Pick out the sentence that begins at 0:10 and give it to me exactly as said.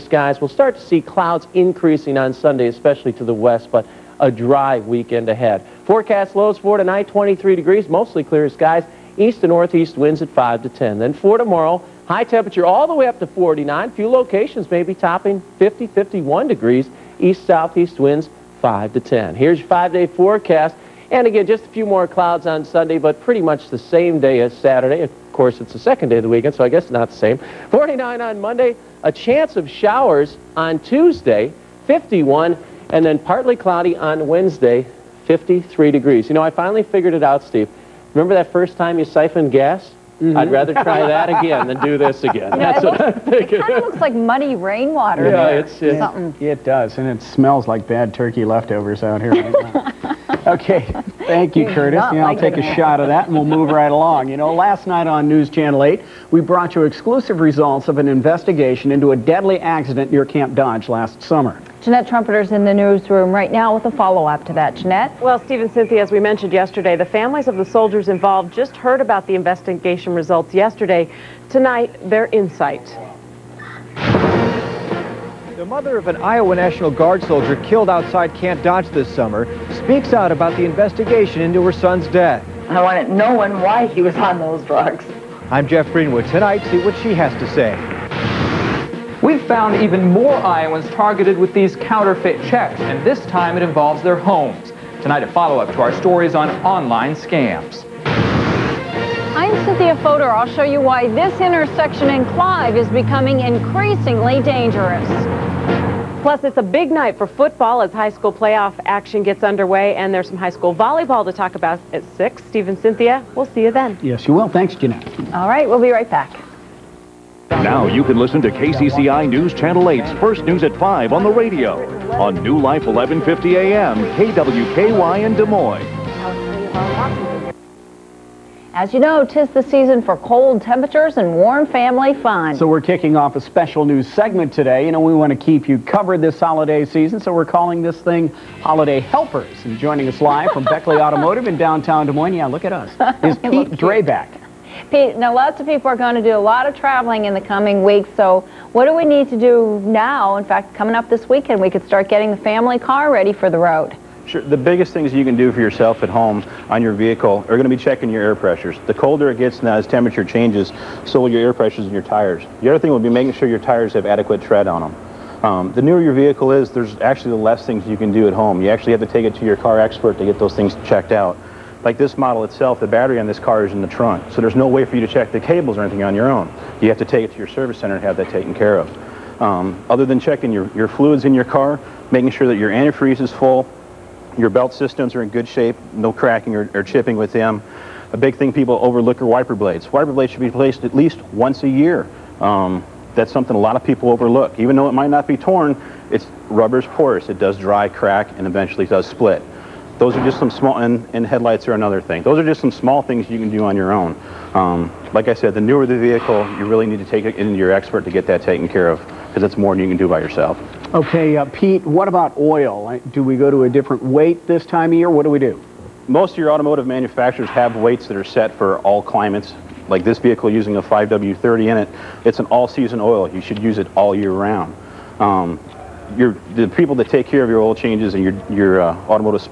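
Then for tomorrow, high temperature all the way up to 49.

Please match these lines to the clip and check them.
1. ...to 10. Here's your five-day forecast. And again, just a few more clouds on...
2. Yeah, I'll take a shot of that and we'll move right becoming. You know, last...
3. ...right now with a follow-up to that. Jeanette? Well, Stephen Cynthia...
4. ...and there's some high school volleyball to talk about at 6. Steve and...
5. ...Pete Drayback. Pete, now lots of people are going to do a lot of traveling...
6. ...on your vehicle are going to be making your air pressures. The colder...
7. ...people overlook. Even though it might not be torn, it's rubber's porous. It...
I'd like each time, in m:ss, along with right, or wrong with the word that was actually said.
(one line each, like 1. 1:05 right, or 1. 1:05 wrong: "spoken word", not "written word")
1. 0:18 right
2. 0:52 wrong: "along", not "becoming"
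3. 1:03 right
4. 1:49 right
5. 2:23 right
6. 2:36 wrong: "checking", not "making"
7. 3:13 right.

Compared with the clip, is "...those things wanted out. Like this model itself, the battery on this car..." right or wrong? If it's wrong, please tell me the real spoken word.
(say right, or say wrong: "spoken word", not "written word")
wrong: "checked", not "wanted".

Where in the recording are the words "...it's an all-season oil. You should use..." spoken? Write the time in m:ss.
3:42.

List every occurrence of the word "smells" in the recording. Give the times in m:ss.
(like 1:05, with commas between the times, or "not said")
0:47.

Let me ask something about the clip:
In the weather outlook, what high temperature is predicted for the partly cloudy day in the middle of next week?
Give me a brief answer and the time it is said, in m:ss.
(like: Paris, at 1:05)
53 degrees, at 0:35.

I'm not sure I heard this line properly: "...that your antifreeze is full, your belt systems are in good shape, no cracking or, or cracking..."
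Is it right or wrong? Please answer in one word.
wrong.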